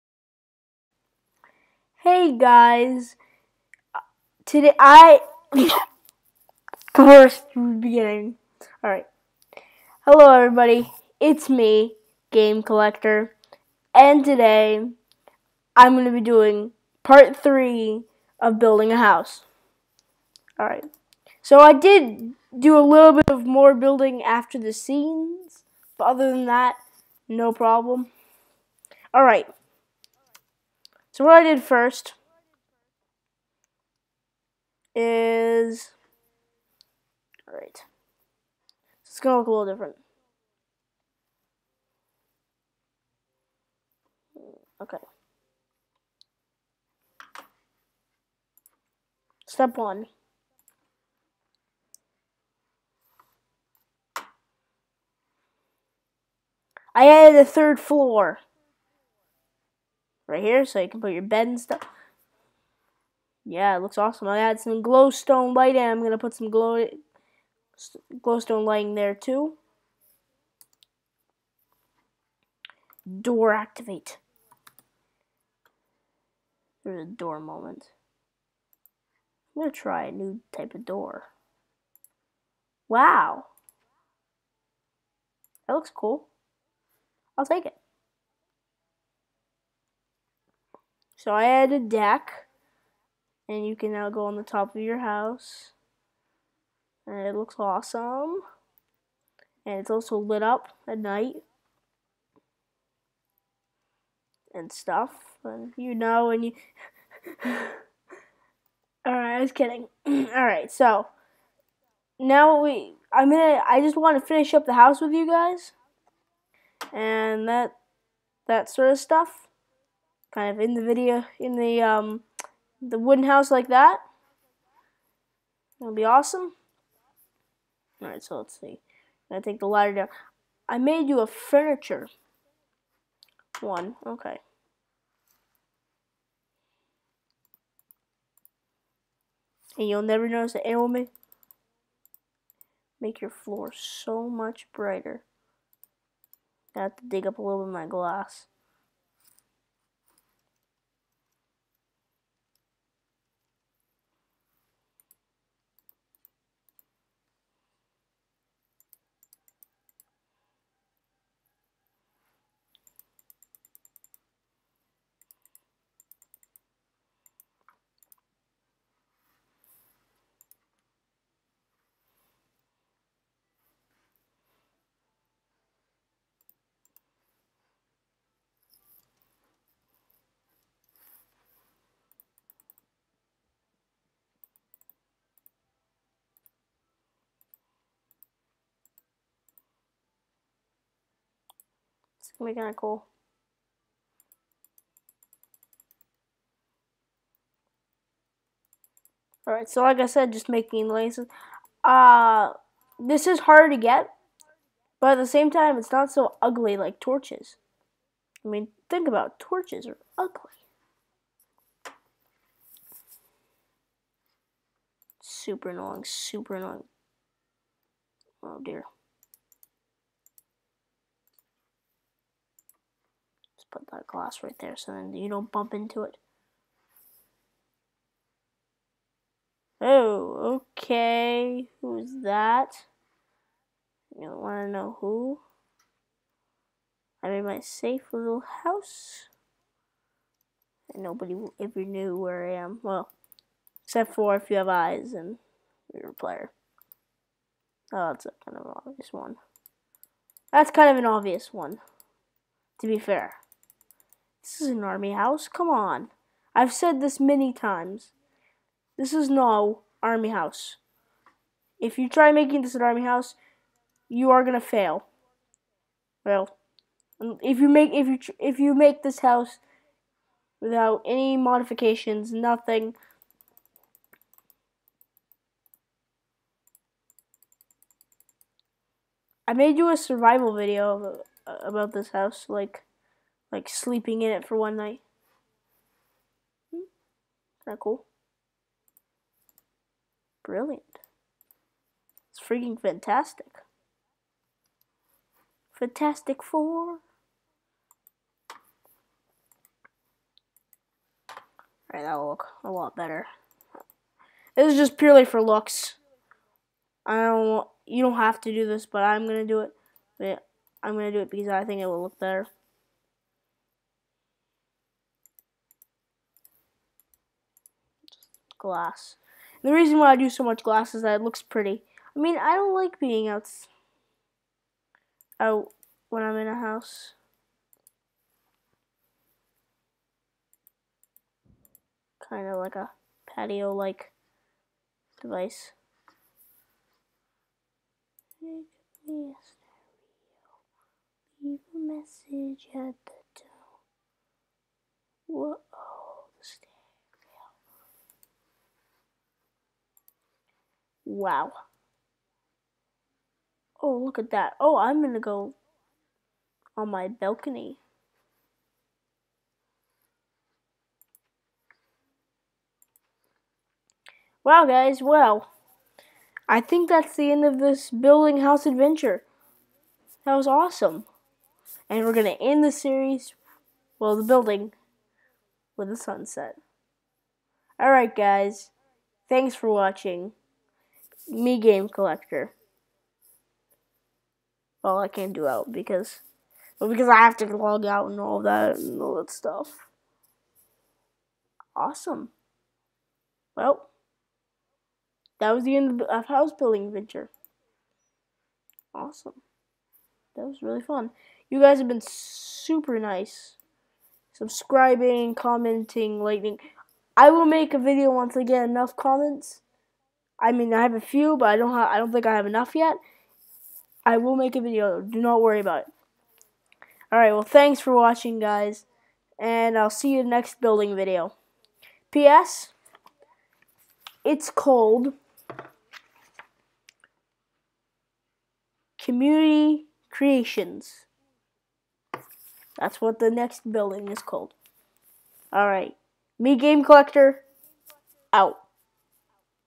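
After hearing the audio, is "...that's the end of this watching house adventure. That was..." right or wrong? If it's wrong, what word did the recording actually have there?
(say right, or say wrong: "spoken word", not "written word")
wrong: "building", not "watching".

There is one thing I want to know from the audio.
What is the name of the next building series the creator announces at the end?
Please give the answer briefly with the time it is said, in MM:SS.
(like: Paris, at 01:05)
Community Creations, at 07:08.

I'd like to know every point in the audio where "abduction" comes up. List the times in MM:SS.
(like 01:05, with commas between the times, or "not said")
not said.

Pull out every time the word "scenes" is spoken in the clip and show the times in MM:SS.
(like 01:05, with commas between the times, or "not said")
00:24.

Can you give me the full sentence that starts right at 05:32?
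Kind of like a patio-like device.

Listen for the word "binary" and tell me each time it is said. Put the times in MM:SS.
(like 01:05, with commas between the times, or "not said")
not said.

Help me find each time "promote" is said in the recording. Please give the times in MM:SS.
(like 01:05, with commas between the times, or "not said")
not said.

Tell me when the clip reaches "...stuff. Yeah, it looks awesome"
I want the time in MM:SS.
01:01.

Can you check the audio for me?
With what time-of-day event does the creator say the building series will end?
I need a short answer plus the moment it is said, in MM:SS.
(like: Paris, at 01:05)
a sunset, at 06:15.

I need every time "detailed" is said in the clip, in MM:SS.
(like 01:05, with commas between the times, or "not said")
not said.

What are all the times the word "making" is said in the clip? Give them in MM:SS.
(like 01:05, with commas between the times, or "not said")
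03:20, 04:22.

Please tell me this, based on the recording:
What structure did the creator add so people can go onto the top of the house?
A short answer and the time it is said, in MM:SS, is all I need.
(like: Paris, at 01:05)
a deck, at 01:31.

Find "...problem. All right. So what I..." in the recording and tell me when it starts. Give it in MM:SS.
00:27.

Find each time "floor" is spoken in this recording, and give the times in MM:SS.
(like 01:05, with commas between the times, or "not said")
00:57, 02:23.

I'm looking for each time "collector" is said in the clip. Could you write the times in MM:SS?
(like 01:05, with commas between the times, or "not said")
00:12, 06:21, 07:16.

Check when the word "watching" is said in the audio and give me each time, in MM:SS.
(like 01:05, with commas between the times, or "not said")
06:19, 06:57.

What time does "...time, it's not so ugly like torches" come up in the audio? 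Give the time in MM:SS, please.
03:25.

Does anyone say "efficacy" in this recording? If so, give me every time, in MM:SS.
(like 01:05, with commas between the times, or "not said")
not said.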